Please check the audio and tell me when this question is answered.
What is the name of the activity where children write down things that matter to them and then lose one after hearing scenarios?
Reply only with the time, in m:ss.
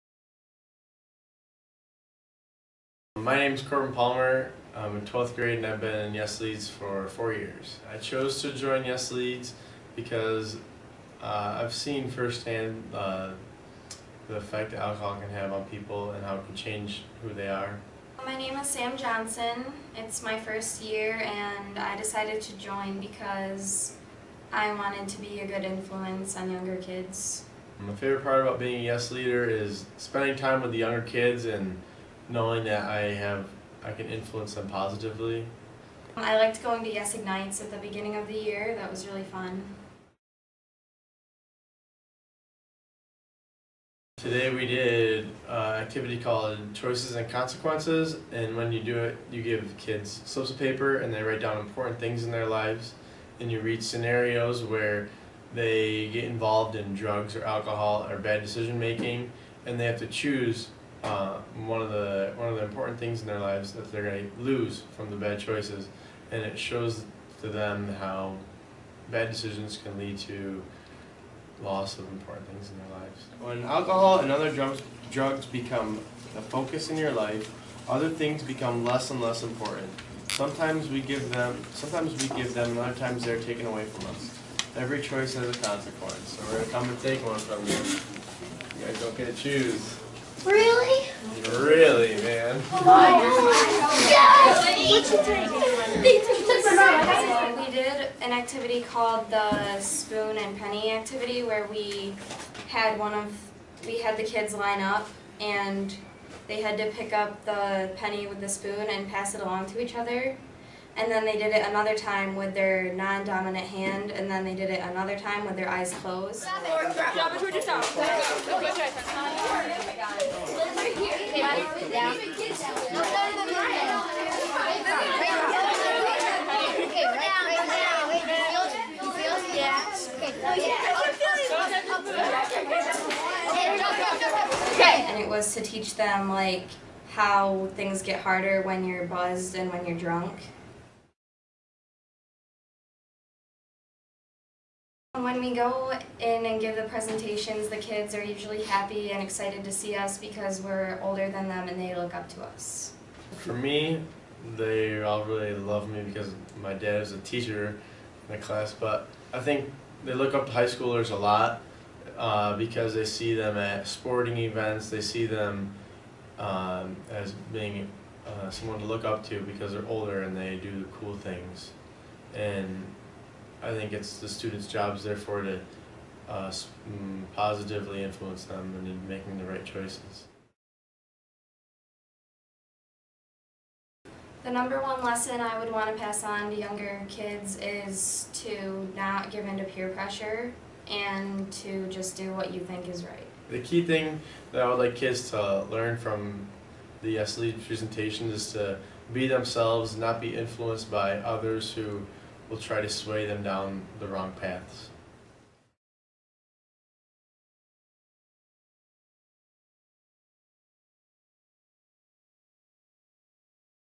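0:46.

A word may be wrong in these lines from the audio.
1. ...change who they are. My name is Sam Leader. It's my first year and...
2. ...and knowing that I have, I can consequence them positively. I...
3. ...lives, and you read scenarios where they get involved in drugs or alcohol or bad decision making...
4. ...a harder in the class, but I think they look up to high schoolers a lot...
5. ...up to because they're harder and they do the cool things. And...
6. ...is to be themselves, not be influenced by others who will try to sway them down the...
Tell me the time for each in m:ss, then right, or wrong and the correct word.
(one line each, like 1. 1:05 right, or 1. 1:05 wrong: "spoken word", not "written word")
1. 0:16 wrong: "Johnson", not "Leader"
2. 0:31 wrong: "influence", not "consequence"
3. 0:52 right
4. 2:37 wrong: "teacher", not "harder"
5. 2:49 wrong: "older", not "harder"
6. 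3:18 right.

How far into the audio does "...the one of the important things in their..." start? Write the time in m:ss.
1:01.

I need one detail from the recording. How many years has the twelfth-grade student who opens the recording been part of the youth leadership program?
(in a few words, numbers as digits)
4.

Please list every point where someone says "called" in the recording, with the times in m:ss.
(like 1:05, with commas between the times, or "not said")
0:46, 1:38.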